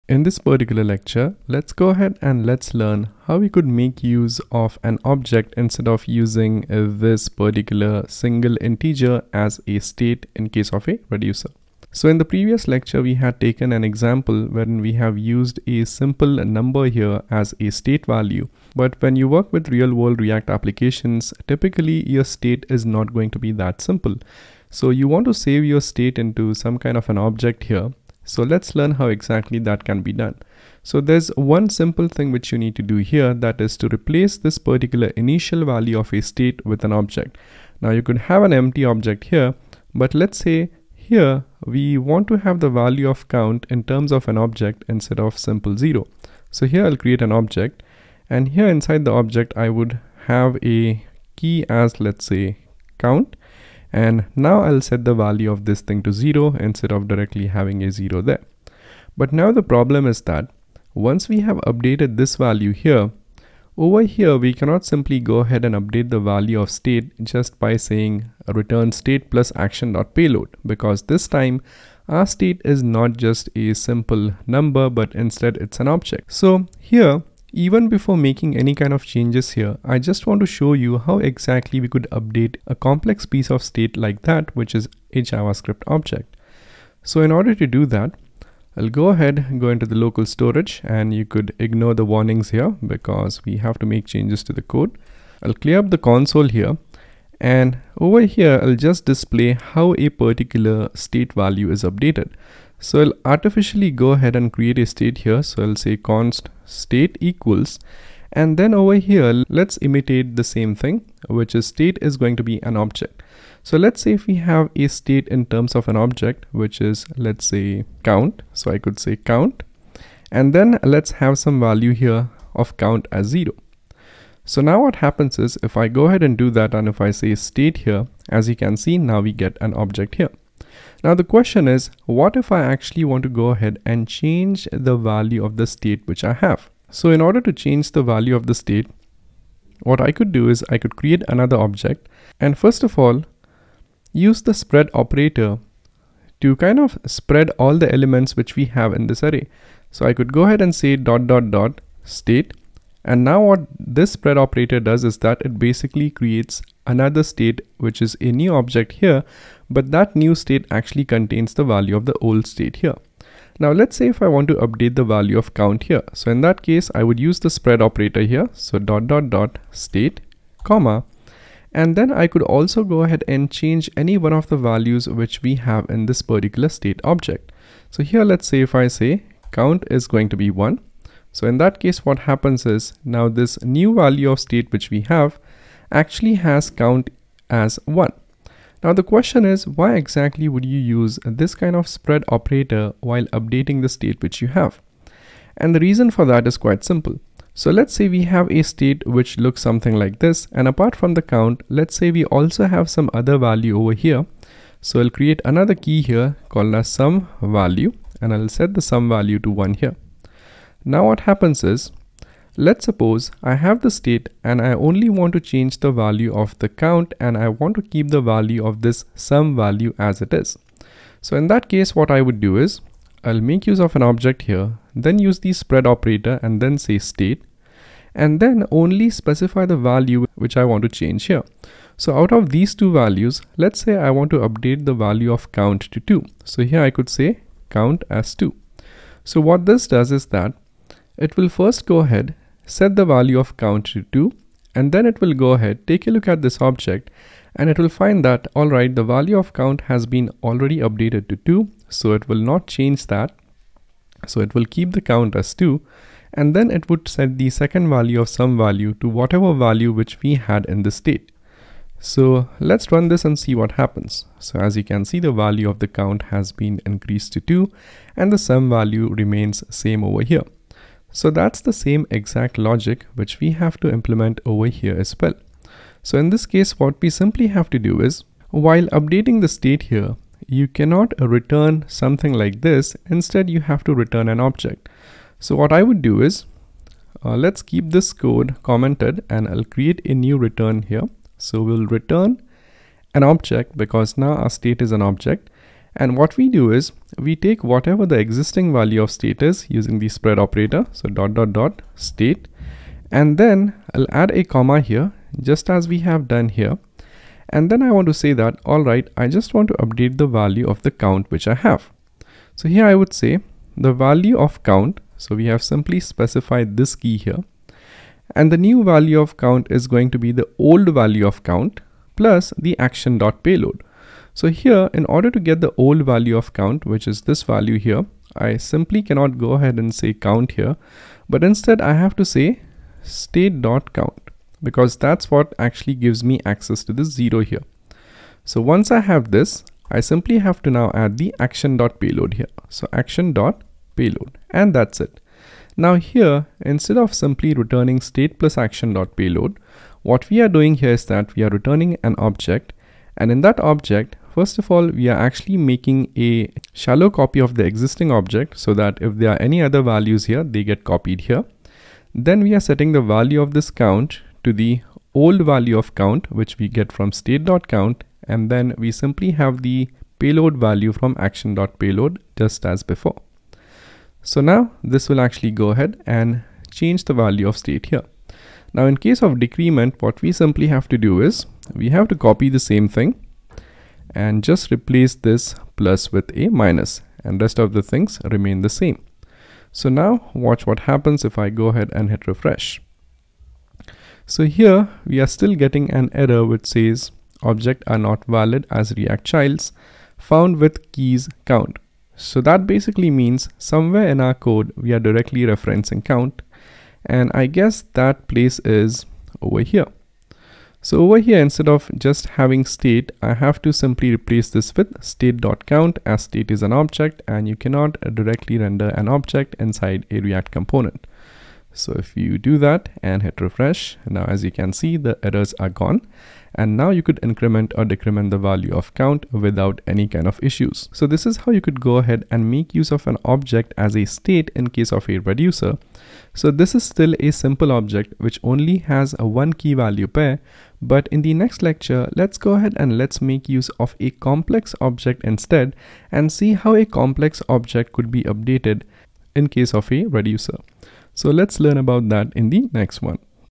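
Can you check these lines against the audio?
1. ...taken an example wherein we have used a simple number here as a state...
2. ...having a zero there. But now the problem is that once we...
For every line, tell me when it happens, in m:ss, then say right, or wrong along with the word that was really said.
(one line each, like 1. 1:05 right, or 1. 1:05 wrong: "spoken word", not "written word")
1. 0:13 right
2. 0:57 right.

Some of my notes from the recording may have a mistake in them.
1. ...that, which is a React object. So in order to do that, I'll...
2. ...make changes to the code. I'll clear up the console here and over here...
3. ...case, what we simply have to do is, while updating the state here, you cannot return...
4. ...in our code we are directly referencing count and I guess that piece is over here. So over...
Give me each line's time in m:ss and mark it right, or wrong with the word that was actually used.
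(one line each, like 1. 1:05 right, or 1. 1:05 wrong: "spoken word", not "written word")
1. 1:24 wrong: "JavaScript", not "React"
2. 1:33 right
3. 4:36 right
4. 6:44 wrong: "place", not "piece".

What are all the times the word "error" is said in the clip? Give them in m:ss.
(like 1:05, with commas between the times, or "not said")
6:36, 7:05.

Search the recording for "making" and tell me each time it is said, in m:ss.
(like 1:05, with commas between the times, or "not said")
1:18, 5:55.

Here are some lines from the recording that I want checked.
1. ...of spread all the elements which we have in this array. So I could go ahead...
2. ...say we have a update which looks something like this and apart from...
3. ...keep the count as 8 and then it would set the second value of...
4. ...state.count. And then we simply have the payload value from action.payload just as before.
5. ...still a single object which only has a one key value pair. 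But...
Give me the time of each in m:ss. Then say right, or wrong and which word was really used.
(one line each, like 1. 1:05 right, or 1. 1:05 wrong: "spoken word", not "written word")
1. 2:26 right
2. 3:17 wrong: "state", not "update"
3. 4:14 wrong: "2", not "8"
4. 6:07 right
5. 7:16 wrong: "simple", not "single".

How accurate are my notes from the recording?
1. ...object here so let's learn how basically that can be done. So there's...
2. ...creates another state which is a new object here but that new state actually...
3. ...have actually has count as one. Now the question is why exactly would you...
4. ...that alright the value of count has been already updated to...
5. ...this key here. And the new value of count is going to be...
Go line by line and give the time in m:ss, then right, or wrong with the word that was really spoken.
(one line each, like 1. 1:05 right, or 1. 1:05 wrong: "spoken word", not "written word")
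1. 0:27 wrong: "exactly", not "basically"
2. 2:36 right
3. 3:05 right
4. 4:08 right
5. 5:16 right.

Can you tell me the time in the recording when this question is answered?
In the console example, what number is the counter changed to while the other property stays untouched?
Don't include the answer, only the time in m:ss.
3:54.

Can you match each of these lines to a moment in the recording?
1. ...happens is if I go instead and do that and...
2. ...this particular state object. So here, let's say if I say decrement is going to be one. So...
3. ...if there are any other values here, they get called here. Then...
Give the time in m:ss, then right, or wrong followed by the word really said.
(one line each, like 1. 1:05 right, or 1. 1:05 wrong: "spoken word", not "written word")
1. 2:04 wrong: "ahead", not "instead"
2. 2:56 wrong: "count", not "decrement"
3. 5:59 wrong: "copied", not "called".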